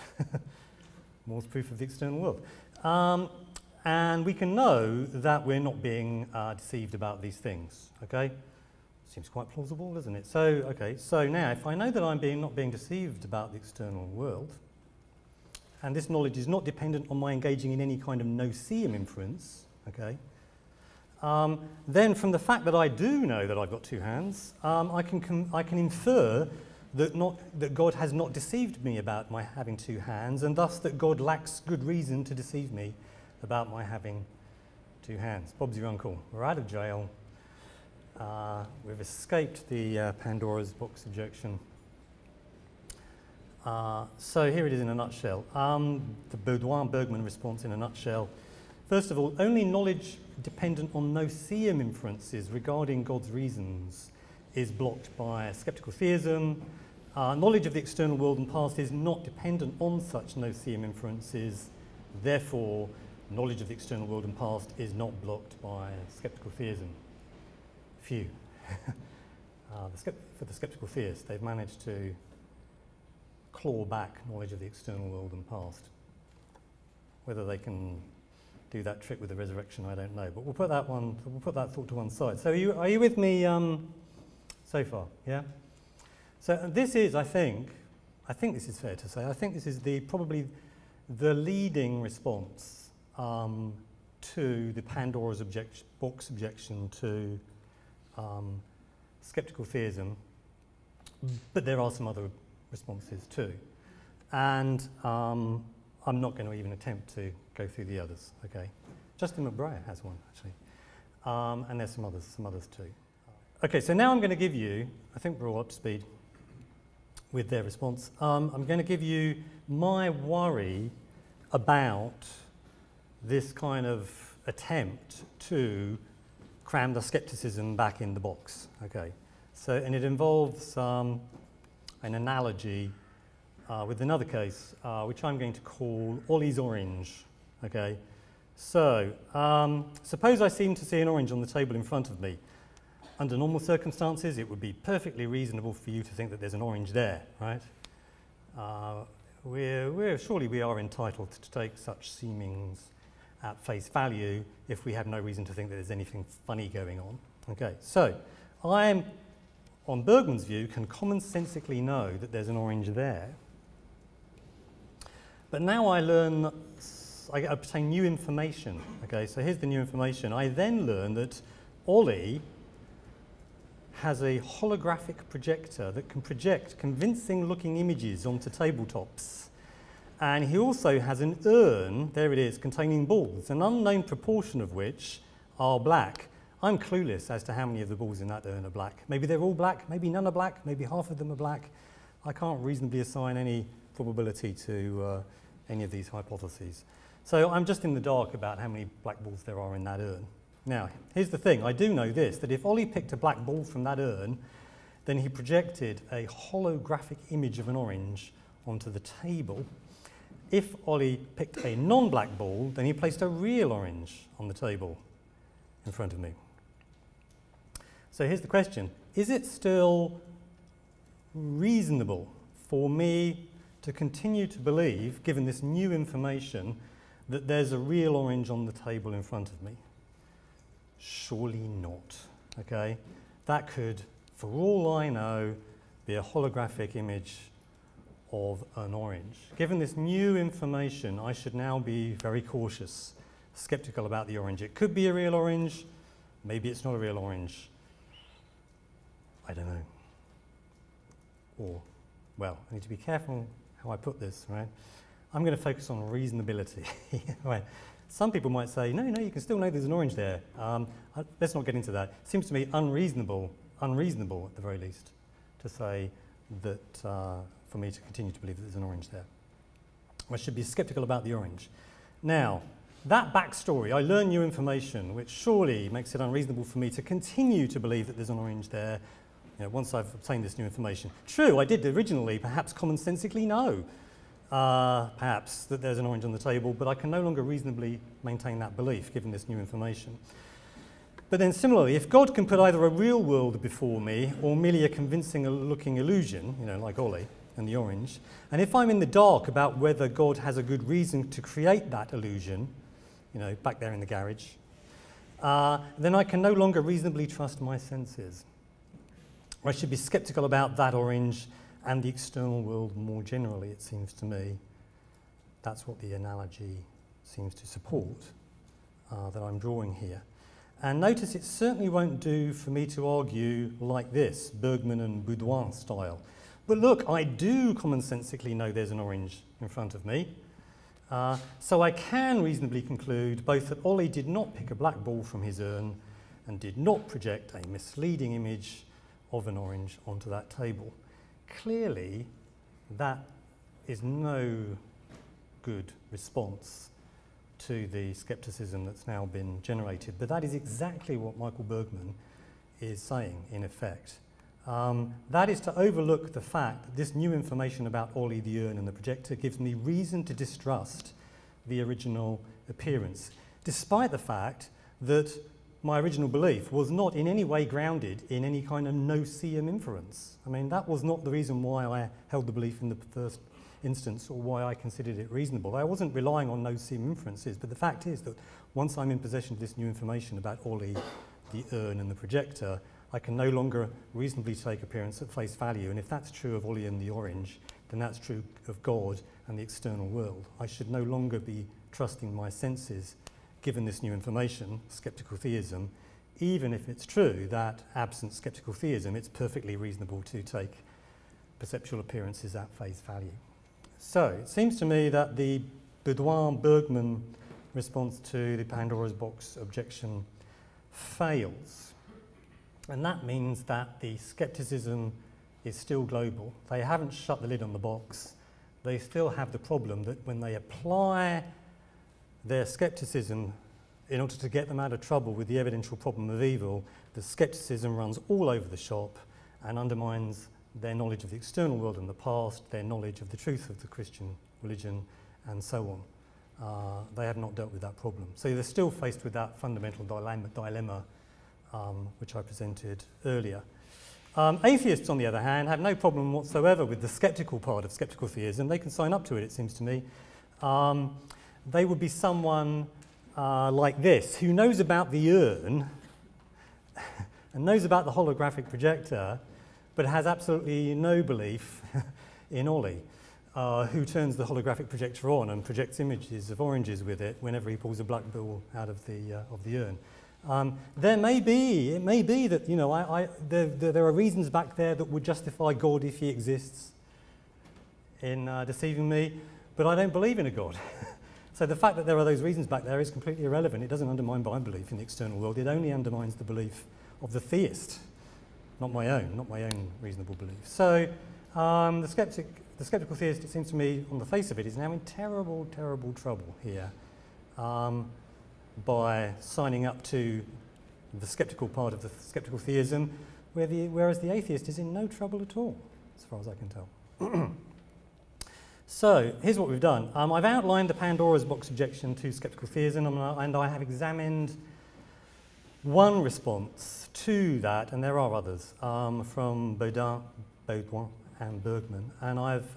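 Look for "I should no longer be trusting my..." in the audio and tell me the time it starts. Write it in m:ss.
6:30.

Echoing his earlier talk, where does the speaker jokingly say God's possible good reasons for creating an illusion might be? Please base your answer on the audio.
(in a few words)
the garage.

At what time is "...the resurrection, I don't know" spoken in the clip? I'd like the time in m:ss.
1:19.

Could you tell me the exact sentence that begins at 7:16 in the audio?
Uh, they have not dealt with that problem.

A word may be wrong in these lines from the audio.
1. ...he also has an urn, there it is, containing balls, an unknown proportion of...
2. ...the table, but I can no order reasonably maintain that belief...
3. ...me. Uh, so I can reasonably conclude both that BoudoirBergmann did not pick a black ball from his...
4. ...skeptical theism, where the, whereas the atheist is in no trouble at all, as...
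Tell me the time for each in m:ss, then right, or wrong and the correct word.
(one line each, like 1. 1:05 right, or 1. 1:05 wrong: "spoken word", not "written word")
1. 3:00 right
2. 4:46 wrong: "longer", not "order"
3. 5:30 wrong: "Ollie", not "BoudoirBergmann"
4. 8:22 right.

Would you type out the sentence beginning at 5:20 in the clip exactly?
And notice it certainly won't do for me to argue like this, Bergmann and Beaudoin style.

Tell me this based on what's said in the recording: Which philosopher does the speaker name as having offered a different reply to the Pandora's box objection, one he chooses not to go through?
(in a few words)
Justin McBrayer.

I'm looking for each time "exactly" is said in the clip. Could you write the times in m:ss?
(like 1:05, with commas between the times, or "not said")
5:50.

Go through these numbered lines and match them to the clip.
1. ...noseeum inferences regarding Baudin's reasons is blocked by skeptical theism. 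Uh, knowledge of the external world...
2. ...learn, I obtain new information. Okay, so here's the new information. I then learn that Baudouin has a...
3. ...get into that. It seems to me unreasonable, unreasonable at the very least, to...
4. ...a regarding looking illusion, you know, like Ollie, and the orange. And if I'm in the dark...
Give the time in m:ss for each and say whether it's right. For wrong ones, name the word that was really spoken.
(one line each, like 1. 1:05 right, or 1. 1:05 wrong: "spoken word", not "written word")
1. 0:51 wrong: "God", not "Baudin"
2. 2:46 wrong: "Ollie", not "Baudouin"
3. 4:21 right
4. 4:54 wrong: "convincing", not "regarding".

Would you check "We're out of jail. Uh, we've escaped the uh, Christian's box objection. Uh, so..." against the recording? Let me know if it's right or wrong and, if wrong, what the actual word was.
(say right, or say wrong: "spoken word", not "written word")
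wrong: "Pandora", not "Christian".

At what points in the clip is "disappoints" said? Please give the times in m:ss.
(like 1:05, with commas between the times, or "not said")
not said.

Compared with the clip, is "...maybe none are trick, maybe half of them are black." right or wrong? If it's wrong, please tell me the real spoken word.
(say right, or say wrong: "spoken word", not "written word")
wrong: "black", not "trick".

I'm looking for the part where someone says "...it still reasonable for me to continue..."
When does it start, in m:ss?
3:39.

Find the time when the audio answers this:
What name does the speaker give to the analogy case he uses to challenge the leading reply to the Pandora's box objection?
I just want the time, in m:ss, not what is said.
2:16.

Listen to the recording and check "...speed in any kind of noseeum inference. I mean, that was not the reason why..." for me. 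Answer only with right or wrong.
wrong.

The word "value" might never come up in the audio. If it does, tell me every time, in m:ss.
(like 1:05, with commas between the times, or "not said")
2:33, 6:25, 6:43.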